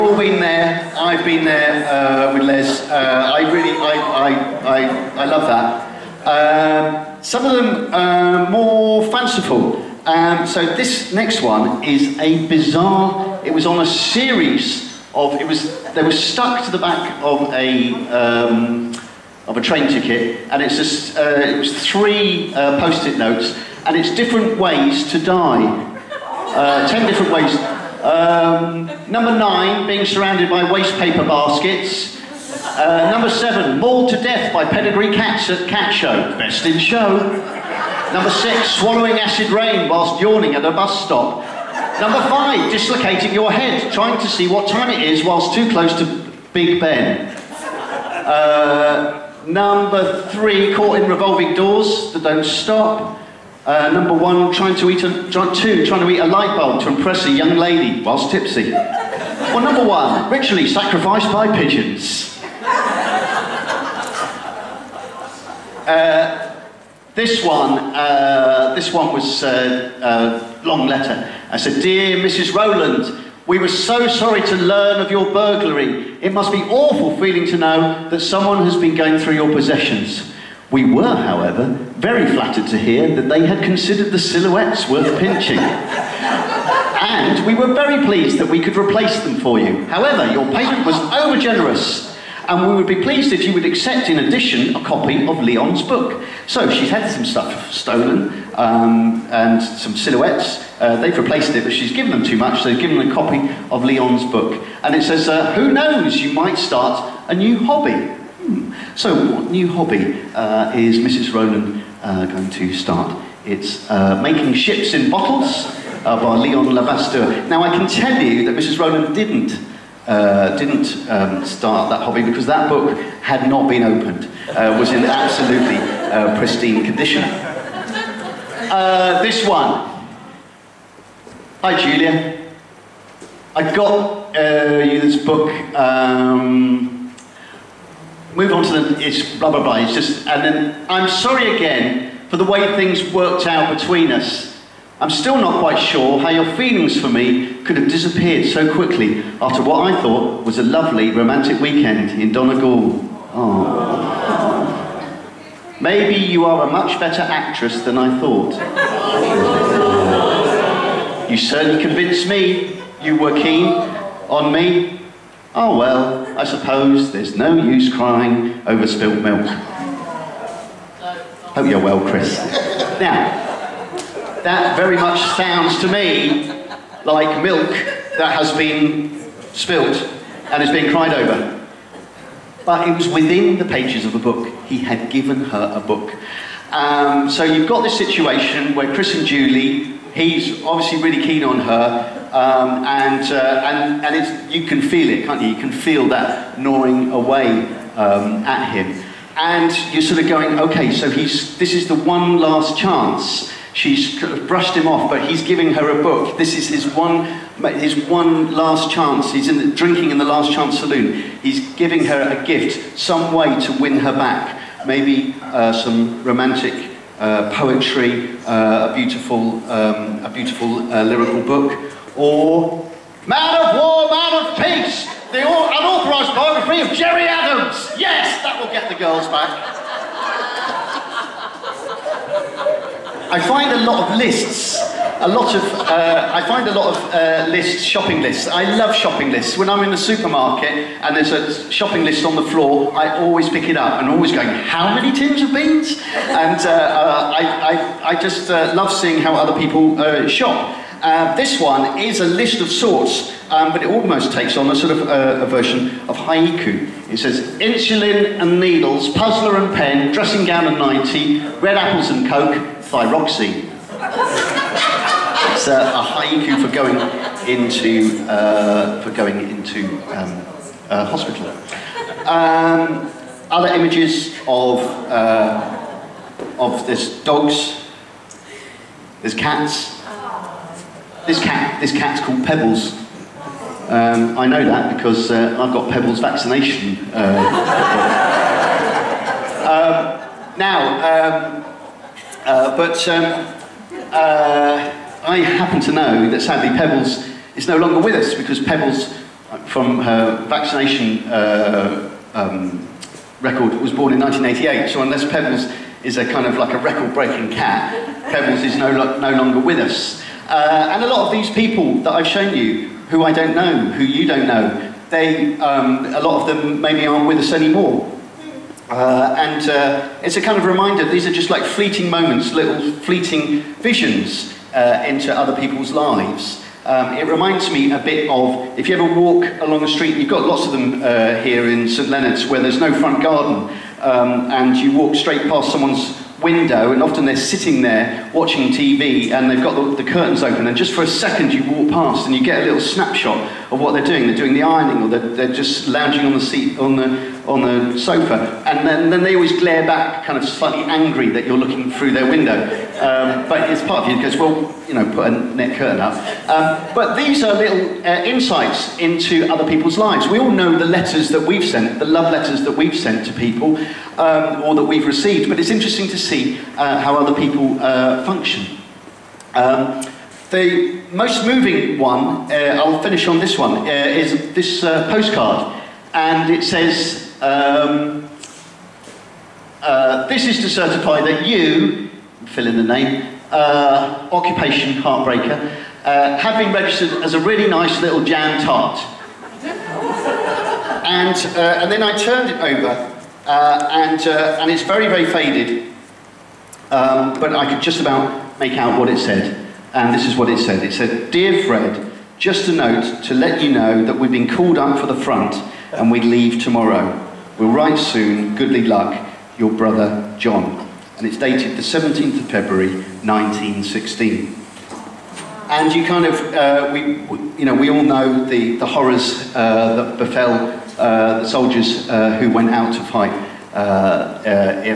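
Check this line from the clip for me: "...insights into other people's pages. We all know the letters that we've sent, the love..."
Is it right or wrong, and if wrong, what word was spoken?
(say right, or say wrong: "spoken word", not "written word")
wrong: "lives", not "pages".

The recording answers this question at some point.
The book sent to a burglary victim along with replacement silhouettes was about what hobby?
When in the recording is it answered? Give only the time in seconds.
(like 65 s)
114 s.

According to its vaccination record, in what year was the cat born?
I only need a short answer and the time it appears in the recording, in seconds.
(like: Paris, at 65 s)
1988, at 304 s.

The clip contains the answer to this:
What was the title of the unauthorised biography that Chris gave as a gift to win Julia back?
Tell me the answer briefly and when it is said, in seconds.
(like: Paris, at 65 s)
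Man of War, Man of Peace, at 223 s.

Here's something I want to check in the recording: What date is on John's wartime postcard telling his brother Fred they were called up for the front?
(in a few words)
17 February 1916.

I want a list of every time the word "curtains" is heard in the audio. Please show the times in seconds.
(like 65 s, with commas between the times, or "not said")
340 s, 355 s.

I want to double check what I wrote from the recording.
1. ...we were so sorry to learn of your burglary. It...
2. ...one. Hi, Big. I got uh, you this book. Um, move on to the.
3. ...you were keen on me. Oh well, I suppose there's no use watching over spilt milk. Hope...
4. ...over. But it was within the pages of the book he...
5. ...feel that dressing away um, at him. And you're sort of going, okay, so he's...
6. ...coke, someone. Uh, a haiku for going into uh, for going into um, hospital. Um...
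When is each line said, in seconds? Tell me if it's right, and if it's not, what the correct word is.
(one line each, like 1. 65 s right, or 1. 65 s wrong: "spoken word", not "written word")
1. 73 s right
2. 129 s wrong: "Julia", not "Big"
3. 163 s wrong: "crying", not "watching"
4. 181 s right
5. 195 s wrong: "gnawing", not "dressing"
6. 262 s wrong: "thyroxine", not "someone".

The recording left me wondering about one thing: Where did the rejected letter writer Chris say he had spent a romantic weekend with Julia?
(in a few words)
Donegal.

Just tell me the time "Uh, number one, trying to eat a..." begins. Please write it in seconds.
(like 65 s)
53 s.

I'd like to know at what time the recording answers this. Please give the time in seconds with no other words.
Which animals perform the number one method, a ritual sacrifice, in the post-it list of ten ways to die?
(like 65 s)
61 s.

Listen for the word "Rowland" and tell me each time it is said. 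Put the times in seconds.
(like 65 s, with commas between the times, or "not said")
72 s, 111 s, 118 s.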